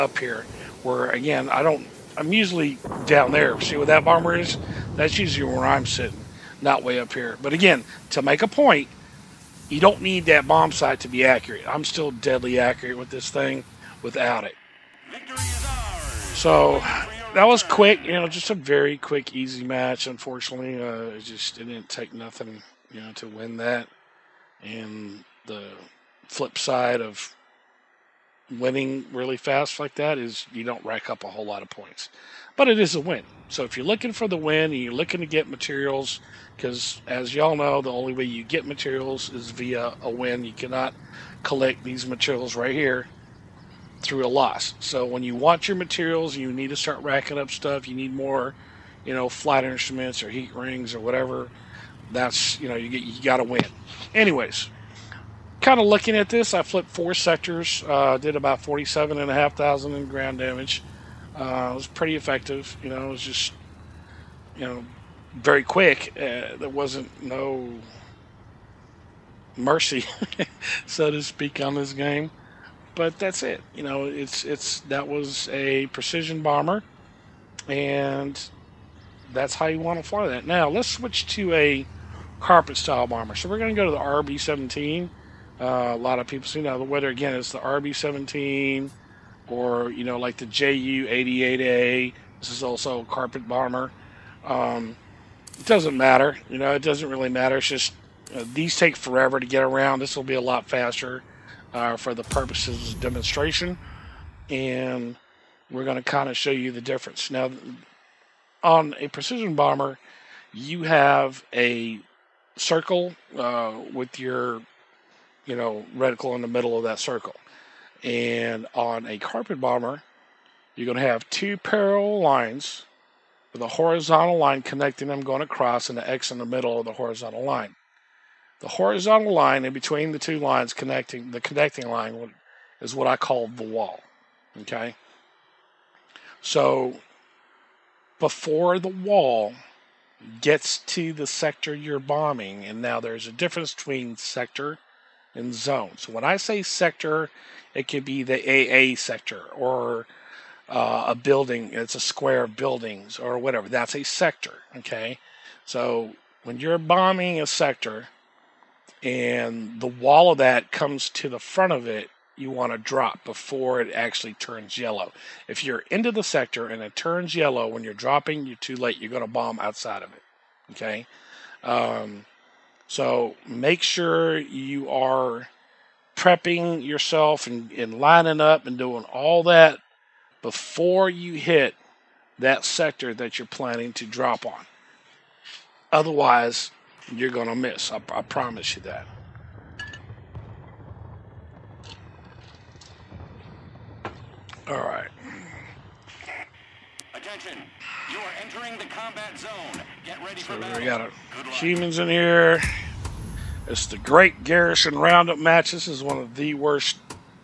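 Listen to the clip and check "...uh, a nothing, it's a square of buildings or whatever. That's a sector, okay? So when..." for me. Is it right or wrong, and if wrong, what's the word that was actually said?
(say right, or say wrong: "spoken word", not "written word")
wrong: "building", not "nothing".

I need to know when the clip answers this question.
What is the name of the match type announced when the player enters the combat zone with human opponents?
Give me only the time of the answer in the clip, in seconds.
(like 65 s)
203 s.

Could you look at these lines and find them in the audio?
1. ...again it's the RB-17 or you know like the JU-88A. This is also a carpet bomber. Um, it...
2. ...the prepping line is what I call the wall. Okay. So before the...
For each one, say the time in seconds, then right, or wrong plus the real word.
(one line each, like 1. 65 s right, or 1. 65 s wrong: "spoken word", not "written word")
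1. 87 s right
2. 131 s wrong: "connecting", not "prepping".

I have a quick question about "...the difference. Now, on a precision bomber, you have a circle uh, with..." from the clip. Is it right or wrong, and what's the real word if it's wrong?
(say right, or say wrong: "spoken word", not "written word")
right.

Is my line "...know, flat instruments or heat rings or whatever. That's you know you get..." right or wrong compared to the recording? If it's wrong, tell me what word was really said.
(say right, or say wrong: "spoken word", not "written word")
right.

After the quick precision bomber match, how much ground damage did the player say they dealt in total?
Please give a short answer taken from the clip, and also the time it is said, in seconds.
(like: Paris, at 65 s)
47,500, at 58 s.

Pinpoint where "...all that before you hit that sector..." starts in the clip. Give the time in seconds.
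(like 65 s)
179 s.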